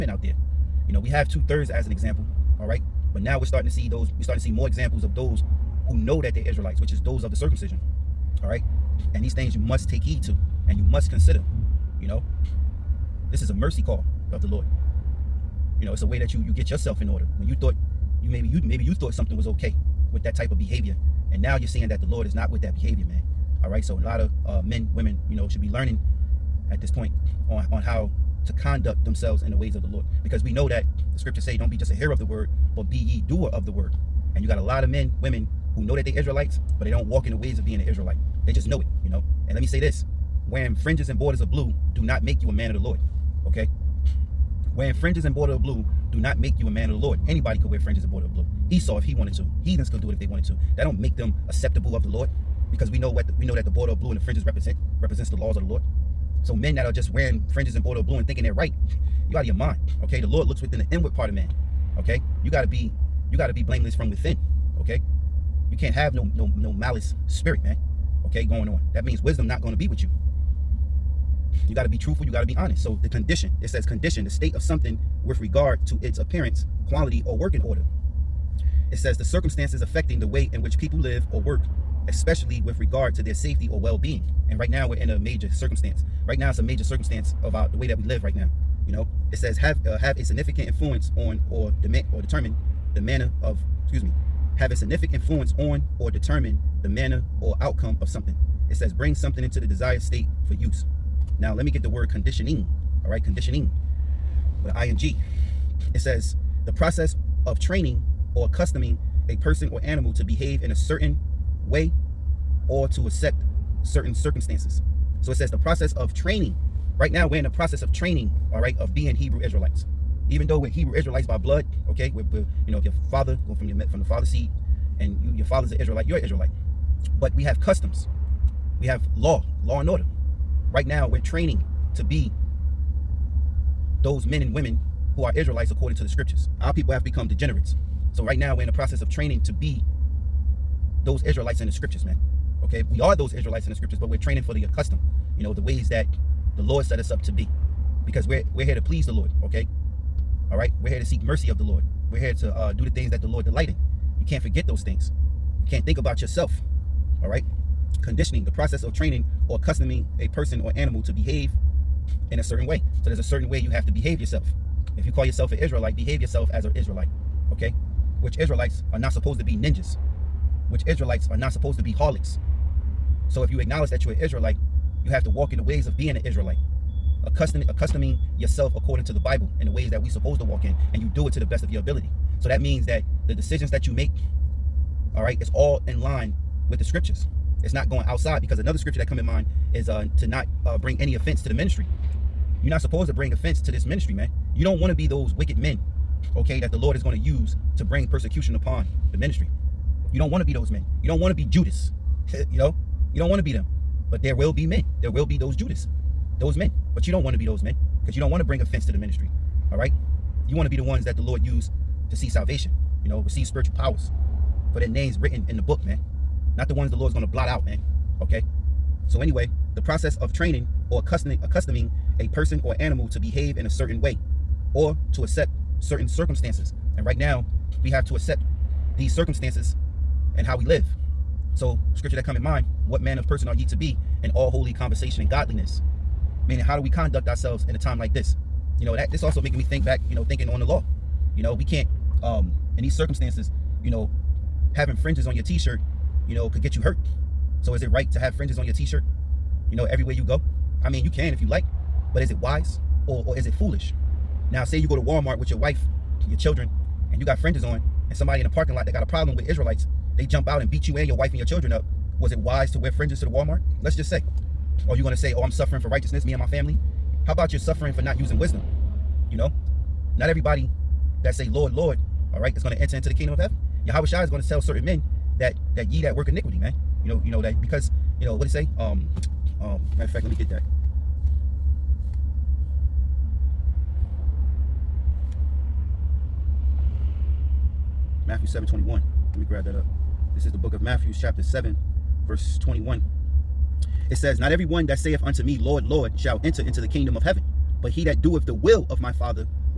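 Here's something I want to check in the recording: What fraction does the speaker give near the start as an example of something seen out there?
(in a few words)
Two thirds.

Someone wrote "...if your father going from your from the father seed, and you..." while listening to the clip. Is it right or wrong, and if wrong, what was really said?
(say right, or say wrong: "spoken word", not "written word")
right.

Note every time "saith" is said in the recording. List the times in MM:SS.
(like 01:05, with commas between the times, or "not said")
04:54.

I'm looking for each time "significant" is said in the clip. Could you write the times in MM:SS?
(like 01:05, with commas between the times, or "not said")
01:30, 01:34.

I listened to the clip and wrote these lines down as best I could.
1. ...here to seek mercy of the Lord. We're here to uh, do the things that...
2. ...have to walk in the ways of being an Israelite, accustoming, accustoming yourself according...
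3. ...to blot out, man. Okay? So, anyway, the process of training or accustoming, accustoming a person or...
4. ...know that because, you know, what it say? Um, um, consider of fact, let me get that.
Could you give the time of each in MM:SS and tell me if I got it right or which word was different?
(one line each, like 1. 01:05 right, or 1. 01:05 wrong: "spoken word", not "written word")
1. 02:30 right
2. 02:55 right
3. 03:37 right
4. 04:37 wrong: "matter", not "consider".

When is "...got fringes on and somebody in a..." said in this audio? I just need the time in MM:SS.
04:17.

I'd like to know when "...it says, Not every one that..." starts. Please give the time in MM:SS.
04:54.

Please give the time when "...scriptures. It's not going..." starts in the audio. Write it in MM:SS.
03:06.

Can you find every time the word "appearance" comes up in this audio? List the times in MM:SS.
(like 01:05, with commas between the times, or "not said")
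01:16.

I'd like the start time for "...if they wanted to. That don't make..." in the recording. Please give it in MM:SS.
00:50.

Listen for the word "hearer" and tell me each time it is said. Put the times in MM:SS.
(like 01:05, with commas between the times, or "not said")
00:31.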